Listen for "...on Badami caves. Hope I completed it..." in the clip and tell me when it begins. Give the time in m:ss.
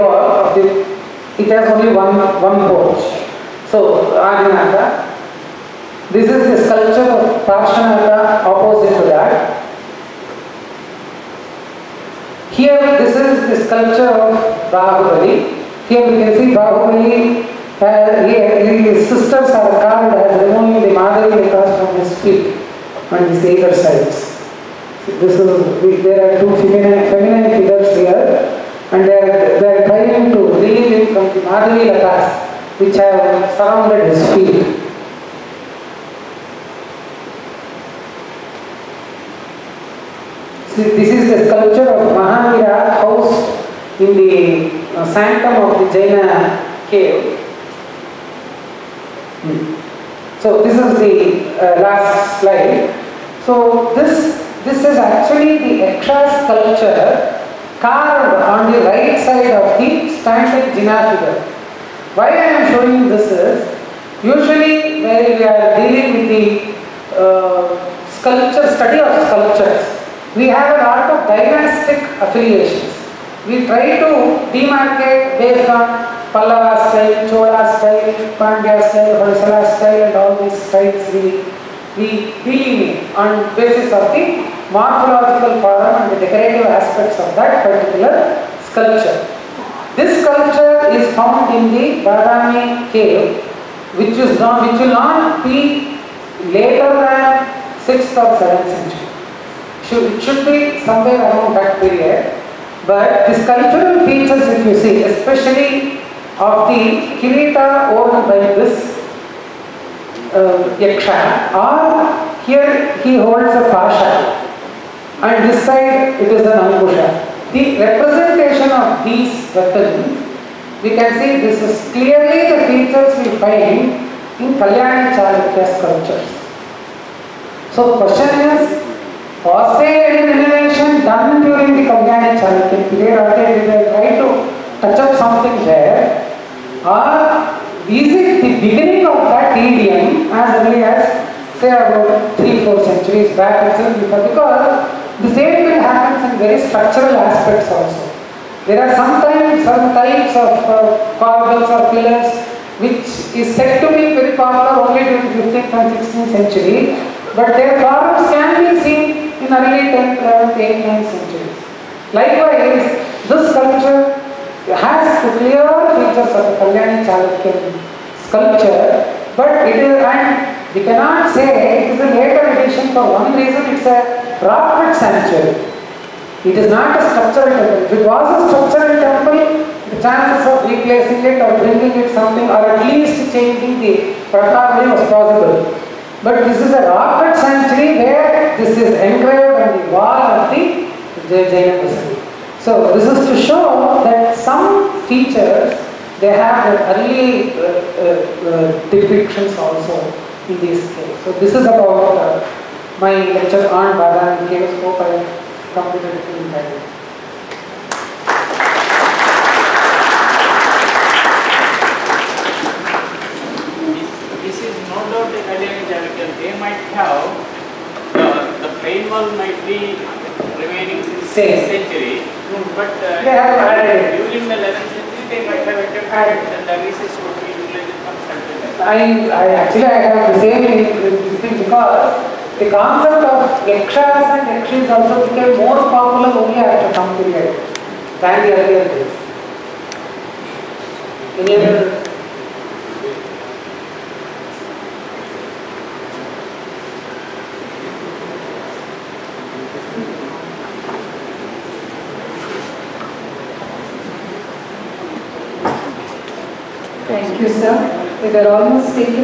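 3:23.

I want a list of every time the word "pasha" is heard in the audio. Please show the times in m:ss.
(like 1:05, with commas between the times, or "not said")
1:53.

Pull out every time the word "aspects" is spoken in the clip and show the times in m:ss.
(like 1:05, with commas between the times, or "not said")
1:26, 2:27.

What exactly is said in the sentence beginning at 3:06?
But this is a rock cut sanctuary where this is engraved on the wall of the Jaina Jainanism.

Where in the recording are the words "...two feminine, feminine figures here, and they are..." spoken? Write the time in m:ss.
0:26.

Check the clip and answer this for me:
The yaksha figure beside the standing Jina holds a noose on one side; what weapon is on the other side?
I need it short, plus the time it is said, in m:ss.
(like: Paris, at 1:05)
ankusha, at 1:56.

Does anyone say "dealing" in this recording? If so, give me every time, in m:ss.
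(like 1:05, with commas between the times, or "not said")
1:05, 1:22.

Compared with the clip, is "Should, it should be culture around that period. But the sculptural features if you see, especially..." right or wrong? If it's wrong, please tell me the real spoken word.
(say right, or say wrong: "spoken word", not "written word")
wrong: "somewhere", not "culture".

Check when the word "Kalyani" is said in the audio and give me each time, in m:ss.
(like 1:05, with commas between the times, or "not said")
2:04, 2:11, 2:46.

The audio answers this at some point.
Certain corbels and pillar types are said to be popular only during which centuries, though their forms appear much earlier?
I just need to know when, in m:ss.
2:35.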